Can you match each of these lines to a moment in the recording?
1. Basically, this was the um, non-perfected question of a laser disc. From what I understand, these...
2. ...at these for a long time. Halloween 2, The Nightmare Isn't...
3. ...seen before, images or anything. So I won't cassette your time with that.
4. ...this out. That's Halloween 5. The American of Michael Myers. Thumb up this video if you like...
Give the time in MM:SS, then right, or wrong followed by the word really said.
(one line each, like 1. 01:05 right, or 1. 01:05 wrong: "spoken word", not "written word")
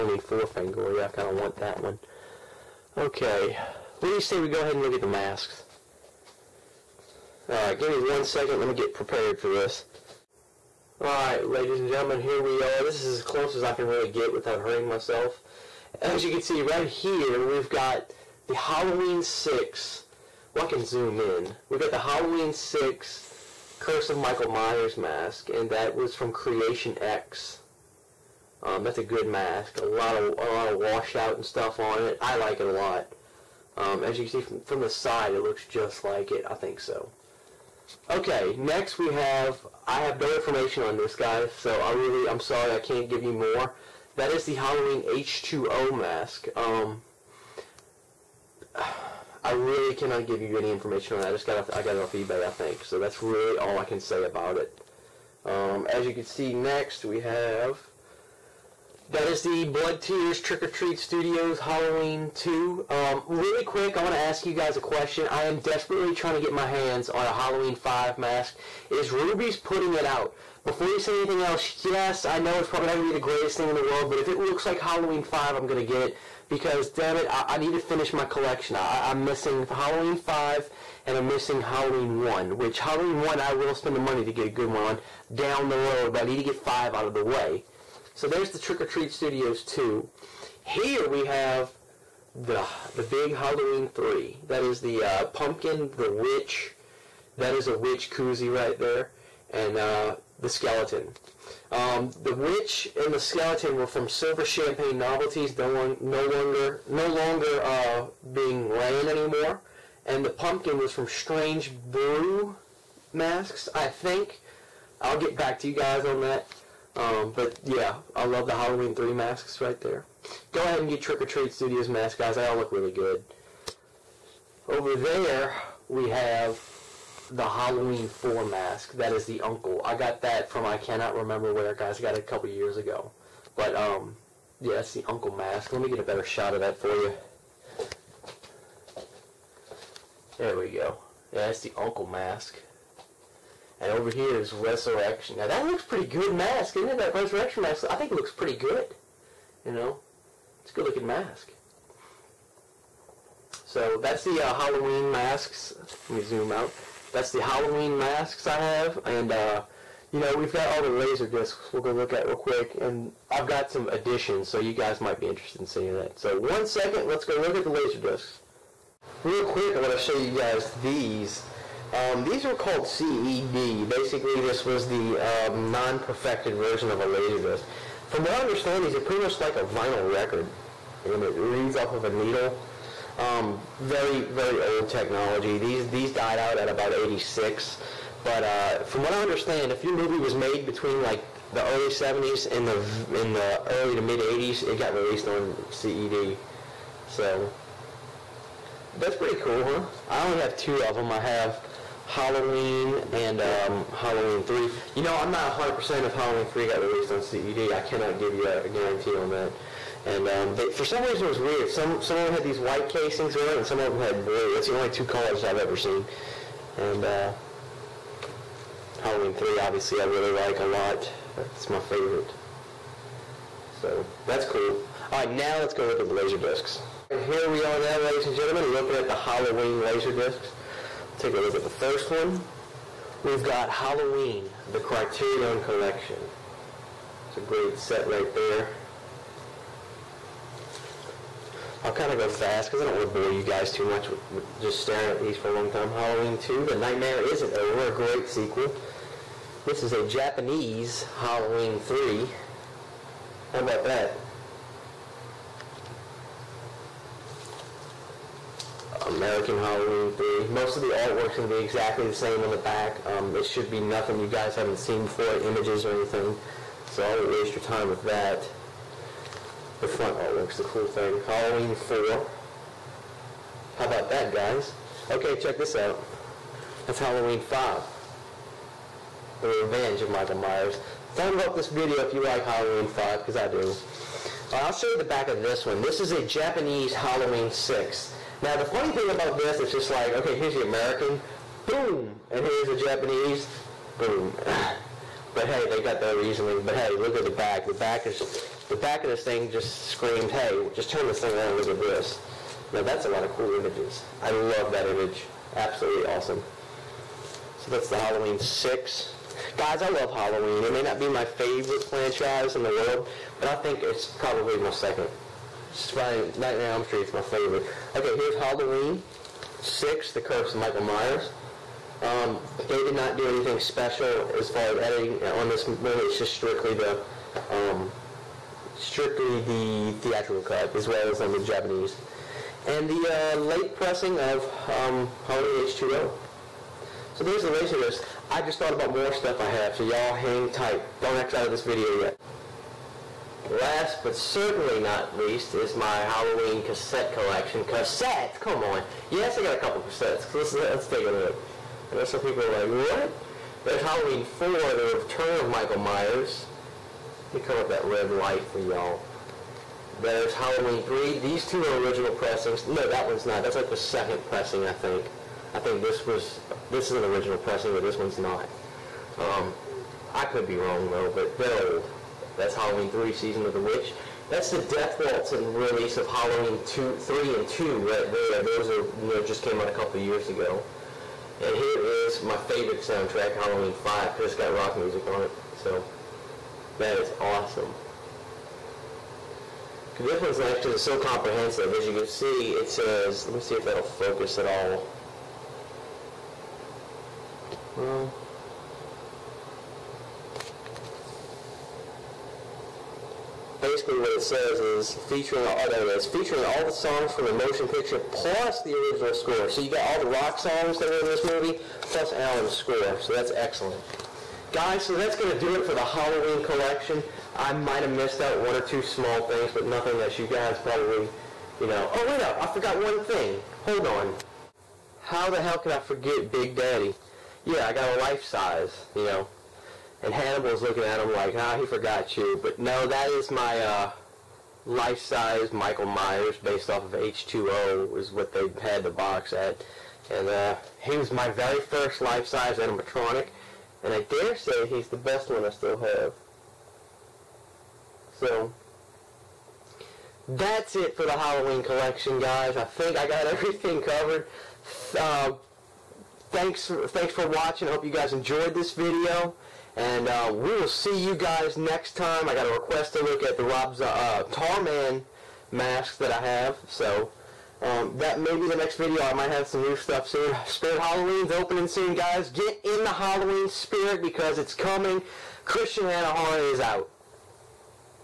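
1. 02:53 wrong: "version", not "question"
2. 04:05 right
3. 04:24 wrong: "waste", not "cassette"
4. 04:35 wrong: "Revenge", not "American".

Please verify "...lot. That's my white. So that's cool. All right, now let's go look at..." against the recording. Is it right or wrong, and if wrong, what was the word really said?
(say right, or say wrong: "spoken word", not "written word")
wrong: "favorite", not "white".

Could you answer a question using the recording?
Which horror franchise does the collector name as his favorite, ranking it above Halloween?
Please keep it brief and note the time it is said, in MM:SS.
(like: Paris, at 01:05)
Nightmare on Elm Street, at 05:16.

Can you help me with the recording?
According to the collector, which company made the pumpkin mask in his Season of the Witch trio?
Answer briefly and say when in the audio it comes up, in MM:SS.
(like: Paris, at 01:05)
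Strange Brew Masks, at 01:51.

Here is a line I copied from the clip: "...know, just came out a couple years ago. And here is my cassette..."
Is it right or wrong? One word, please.
wrong.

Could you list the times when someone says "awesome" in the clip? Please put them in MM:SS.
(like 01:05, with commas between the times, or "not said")
05:06, 06:27.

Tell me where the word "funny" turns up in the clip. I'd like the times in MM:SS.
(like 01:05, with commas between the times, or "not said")
04:48.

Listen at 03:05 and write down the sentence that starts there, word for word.
These these died out at about 86.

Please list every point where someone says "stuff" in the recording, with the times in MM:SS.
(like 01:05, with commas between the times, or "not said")
00:31, 05:39, 07:49.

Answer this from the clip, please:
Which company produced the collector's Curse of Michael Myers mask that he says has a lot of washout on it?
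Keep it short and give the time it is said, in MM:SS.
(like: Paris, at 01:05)
Creation X, at 00:26.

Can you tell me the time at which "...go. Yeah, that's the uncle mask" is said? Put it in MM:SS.
02:20.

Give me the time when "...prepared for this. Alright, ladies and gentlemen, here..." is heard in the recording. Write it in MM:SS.
00:08.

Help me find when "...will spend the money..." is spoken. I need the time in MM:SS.
01:23.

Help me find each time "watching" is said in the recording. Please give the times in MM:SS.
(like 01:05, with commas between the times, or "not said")
07:37.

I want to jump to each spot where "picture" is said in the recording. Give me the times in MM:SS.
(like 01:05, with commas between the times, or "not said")
06:47.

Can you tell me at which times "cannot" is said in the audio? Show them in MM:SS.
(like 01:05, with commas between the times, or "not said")
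00:49, 02:10, 03:27.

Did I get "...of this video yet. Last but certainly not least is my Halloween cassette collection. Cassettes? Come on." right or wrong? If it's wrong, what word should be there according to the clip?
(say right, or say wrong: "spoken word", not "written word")
right.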